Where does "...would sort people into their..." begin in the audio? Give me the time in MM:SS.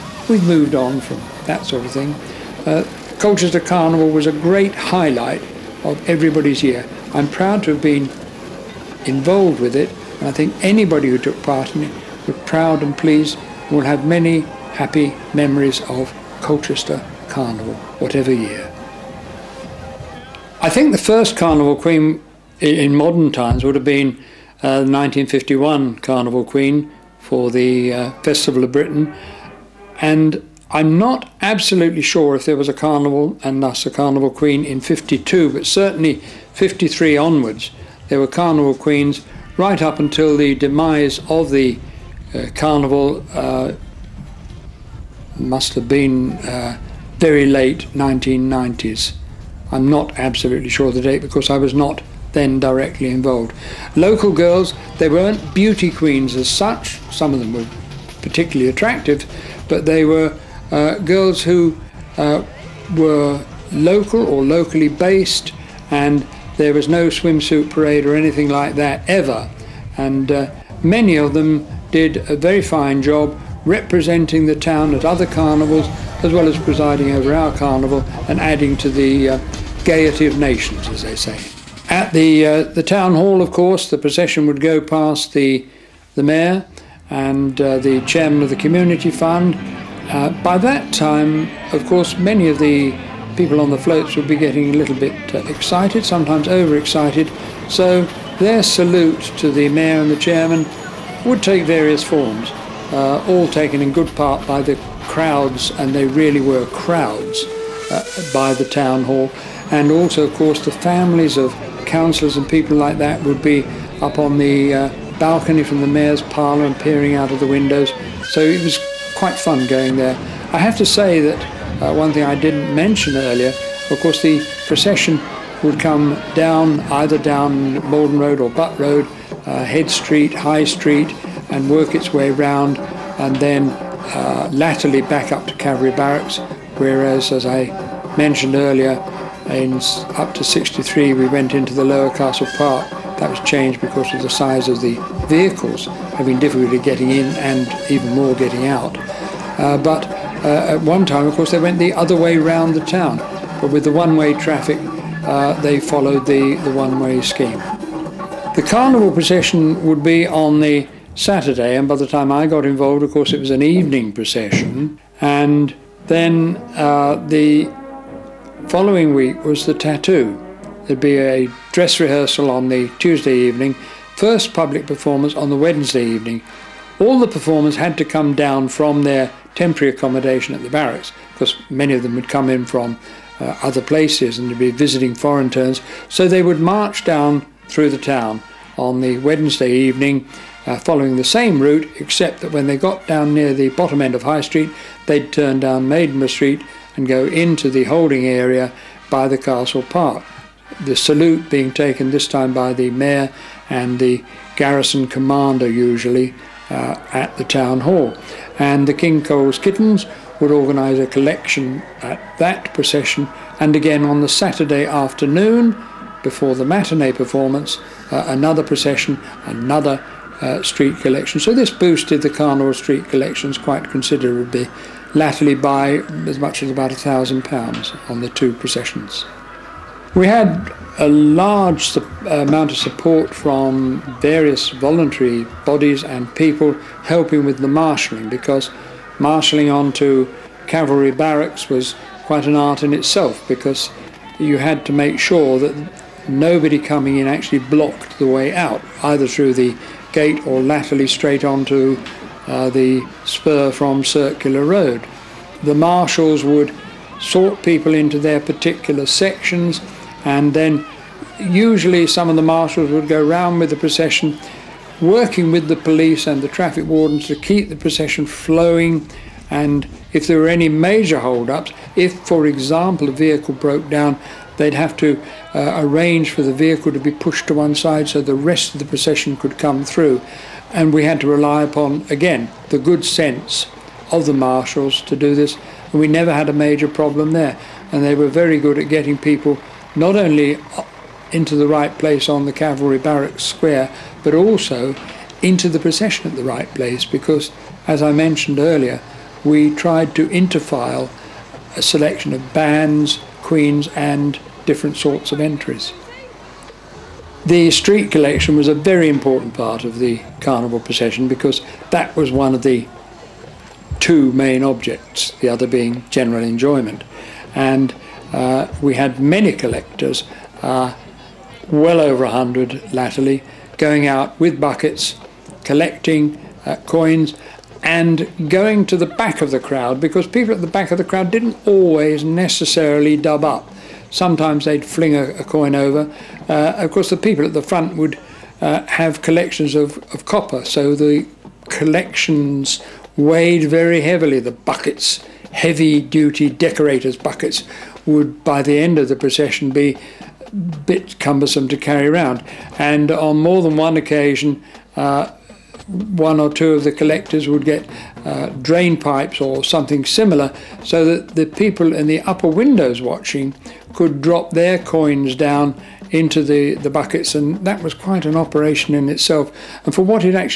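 04:16.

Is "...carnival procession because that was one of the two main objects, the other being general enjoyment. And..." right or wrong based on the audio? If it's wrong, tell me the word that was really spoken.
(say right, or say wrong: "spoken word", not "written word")
right.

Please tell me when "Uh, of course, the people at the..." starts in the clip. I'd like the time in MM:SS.
05:36.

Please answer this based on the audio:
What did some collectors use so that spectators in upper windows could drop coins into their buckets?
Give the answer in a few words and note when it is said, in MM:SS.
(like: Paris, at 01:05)
Drain pipes, at 05:58.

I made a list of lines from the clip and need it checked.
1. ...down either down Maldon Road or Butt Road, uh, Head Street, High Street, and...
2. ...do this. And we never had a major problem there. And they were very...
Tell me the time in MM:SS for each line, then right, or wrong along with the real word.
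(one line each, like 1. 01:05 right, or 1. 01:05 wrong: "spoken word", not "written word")
1. 02:06 right
2. 04:45 right.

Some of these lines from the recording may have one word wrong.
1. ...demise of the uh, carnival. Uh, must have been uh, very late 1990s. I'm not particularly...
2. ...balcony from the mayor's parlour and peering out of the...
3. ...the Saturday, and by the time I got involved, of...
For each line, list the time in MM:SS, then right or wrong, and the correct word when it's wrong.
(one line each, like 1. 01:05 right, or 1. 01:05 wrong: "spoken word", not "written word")
1. 00:40 wrong: "absolutely", not "particularly"
2. 01:55 right
3. 02:40 right.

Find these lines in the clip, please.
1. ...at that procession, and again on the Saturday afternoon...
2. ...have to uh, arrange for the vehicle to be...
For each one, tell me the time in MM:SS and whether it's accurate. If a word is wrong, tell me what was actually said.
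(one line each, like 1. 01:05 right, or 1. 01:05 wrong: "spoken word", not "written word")
1. 03:32 right
2. 04:34 right.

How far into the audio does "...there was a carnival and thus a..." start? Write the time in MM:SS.
00:32.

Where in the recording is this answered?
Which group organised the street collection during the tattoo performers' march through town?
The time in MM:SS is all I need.
03:28.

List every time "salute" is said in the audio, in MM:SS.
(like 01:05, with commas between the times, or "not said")
01:38, 03:20.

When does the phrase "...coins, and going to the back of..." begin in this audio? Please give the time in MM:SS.
05:26.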